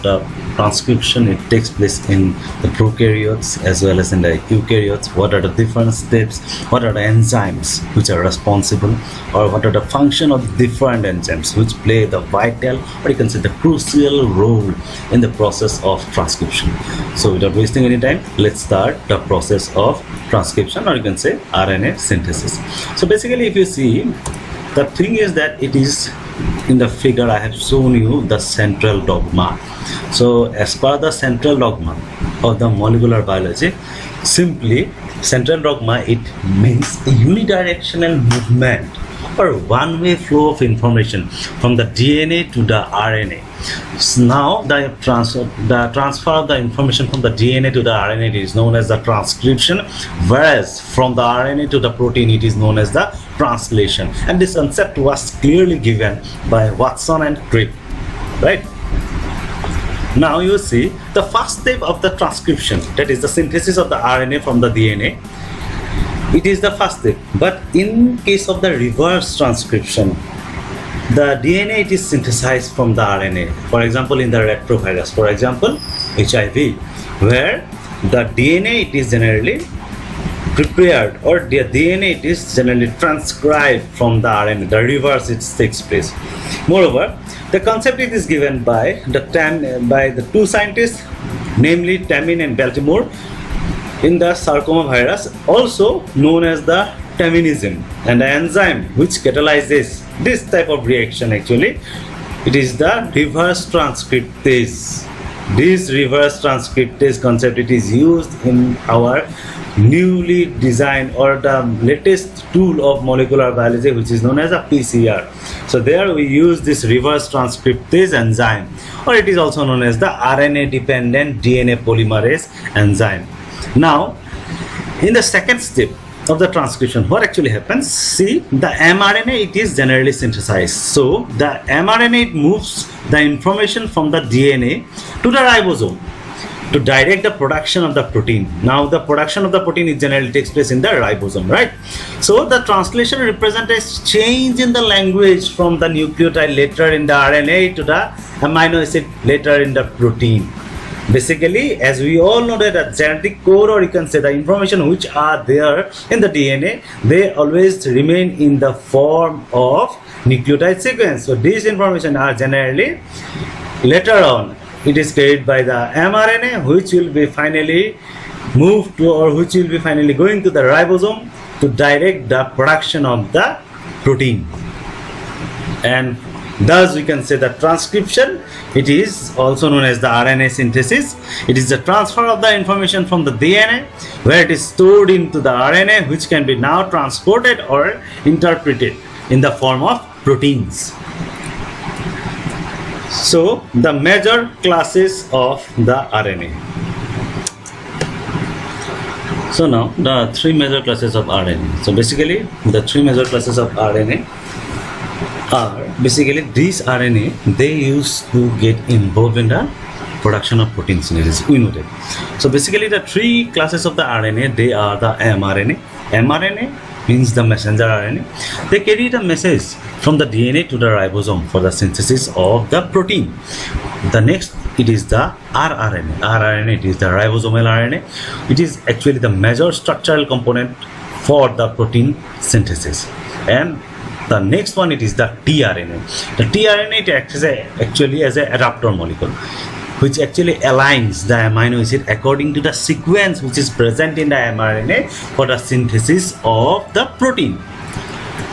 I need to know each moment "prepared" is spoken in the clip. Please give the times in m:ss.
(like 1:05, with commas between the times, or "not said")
1:20.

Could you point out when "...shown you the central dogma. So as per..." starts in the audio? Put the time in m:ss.
0:27.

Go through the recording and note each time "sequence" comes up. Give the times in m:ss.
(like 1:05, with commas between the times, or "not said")
2:40, 4:02.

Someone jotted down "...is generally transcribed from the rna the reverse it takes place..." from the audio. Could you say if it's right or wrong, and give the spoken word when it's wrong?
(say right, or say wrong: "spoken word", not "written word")
right.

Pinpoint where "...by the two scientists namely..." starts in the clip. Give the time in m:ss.
1:29.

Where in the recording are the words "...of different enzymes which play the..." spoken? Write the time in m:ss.
0:10.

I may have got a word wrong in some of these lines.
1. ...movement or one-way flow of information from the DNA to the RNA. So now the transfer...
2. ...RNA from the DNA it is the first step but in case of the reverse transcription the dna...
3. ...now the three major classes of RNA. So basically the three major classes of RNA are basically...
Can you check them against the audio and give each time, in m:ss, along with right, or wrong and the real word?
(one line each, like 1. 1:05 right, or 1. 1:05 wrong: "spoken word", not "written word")
1. 0:38 right
2. 1:03 right
3. 3:19 right.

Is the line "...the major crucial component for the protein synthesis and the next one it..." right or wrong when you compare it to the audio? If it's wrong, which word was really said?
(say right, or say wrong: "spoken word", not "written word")
wrong: "structural", not "crucial".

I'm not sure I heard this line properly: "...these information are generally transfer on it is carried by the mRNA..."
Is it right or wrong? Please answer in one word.
wrong.